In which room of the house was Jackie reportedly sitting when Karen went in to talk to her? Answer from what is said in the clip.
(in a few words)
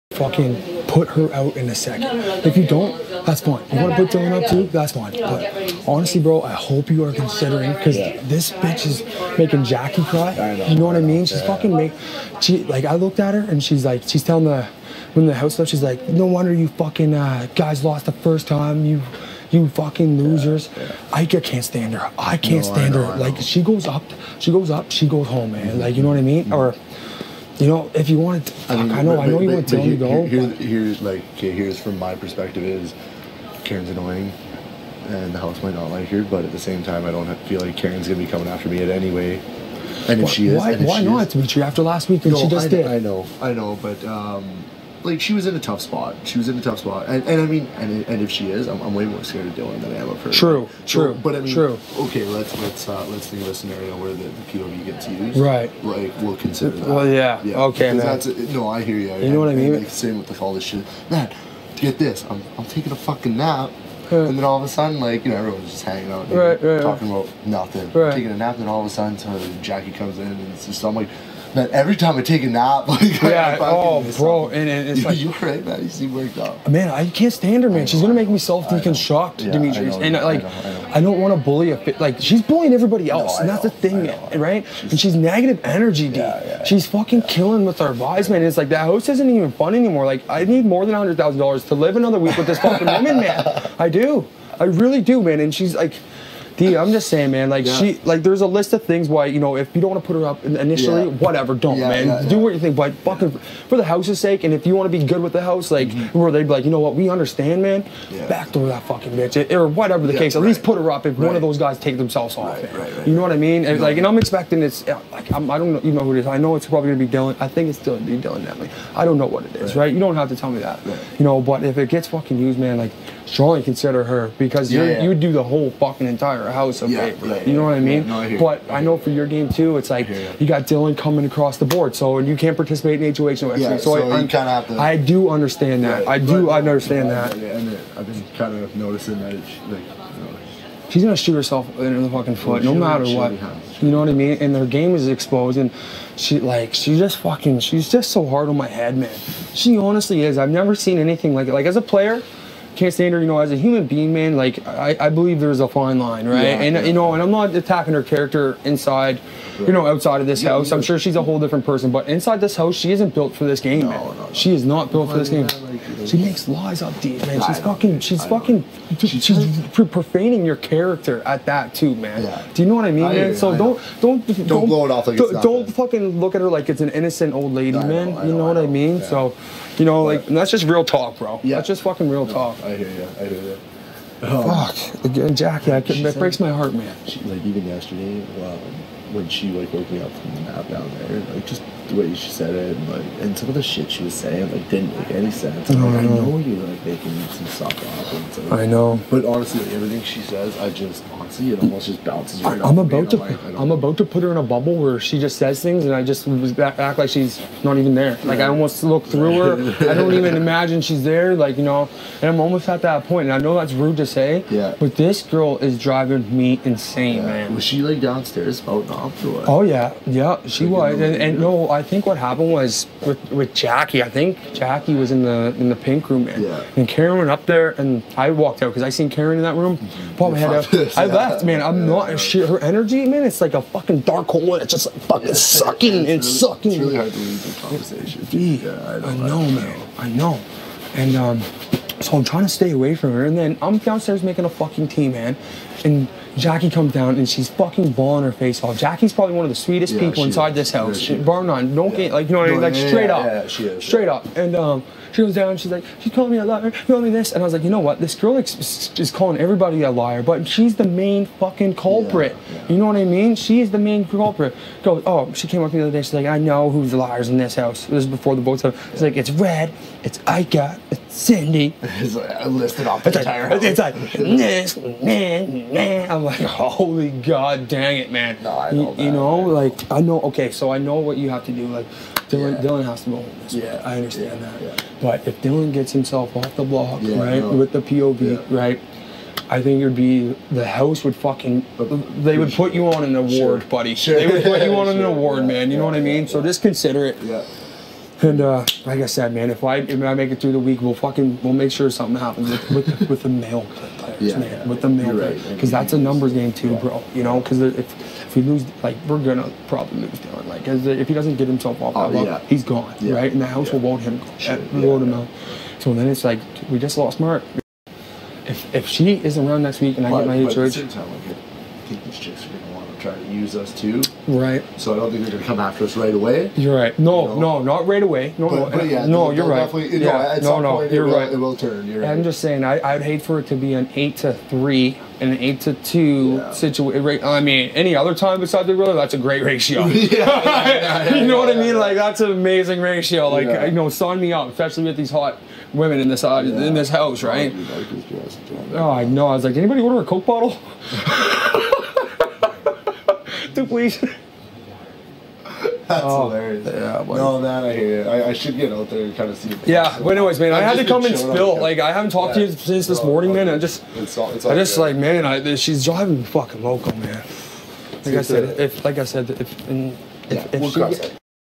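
The pink room.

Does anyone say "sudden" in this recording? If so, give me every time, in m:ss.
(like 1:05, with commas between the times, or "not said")
1:04, 1:08.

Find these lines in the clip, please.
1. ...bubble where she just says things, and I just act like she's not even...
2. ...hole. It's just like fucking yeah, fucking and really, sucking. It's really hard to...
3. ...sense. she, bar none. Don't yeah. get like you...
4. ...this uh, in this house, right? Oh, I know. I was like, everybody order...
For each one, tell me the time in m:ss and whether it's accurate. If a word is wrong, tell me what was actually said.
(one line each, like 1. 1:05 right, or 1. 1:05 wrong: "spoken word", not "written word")
1. 3:24 right
2. 3:54 wrong: "sucking", not "fucking"
3. 4:10 wrong: "house", not "sense"
4. 5:46 wrong: "anybody", not "everybody".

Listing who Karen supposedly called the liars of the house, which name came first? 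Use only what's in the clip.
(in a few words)
Red.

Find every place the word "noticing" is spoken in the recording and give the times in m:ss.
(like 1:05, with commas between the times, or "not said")
2:18.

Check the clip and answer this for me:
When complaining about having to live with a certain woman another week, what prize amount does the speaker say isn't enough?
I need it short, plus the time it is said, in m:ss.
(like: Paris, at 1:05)
$100,000, at 1:30.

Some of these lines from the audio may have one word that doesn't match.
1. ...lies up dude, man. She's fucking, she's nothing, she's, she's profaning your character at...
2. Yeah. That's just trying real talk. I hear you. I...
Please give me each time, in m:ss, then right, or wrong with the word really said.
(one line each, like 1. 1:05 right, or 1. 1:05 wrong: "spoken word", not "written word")
1. 2:46 wrong: "fucking", not "nothing"
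2. 3:01 wrong: "fucking", not "trying".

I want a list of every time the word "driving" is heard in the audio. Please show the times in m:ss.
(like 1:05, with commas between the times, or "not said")
3:35, 6:05.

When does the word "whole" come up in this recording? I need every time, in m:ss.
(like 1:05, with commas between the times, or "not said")
2:05, 2:41.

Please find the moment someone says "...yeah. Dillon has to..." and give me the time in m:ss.
4:42.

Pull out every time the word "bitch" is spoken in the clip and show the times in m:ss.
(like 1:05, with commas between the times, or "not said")
0:08, 1:49.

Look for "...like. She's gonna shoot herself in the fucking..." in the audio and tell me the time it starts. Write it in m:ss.
2:19.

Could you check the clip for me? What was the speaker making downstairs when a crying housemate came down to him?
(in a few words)
Tea.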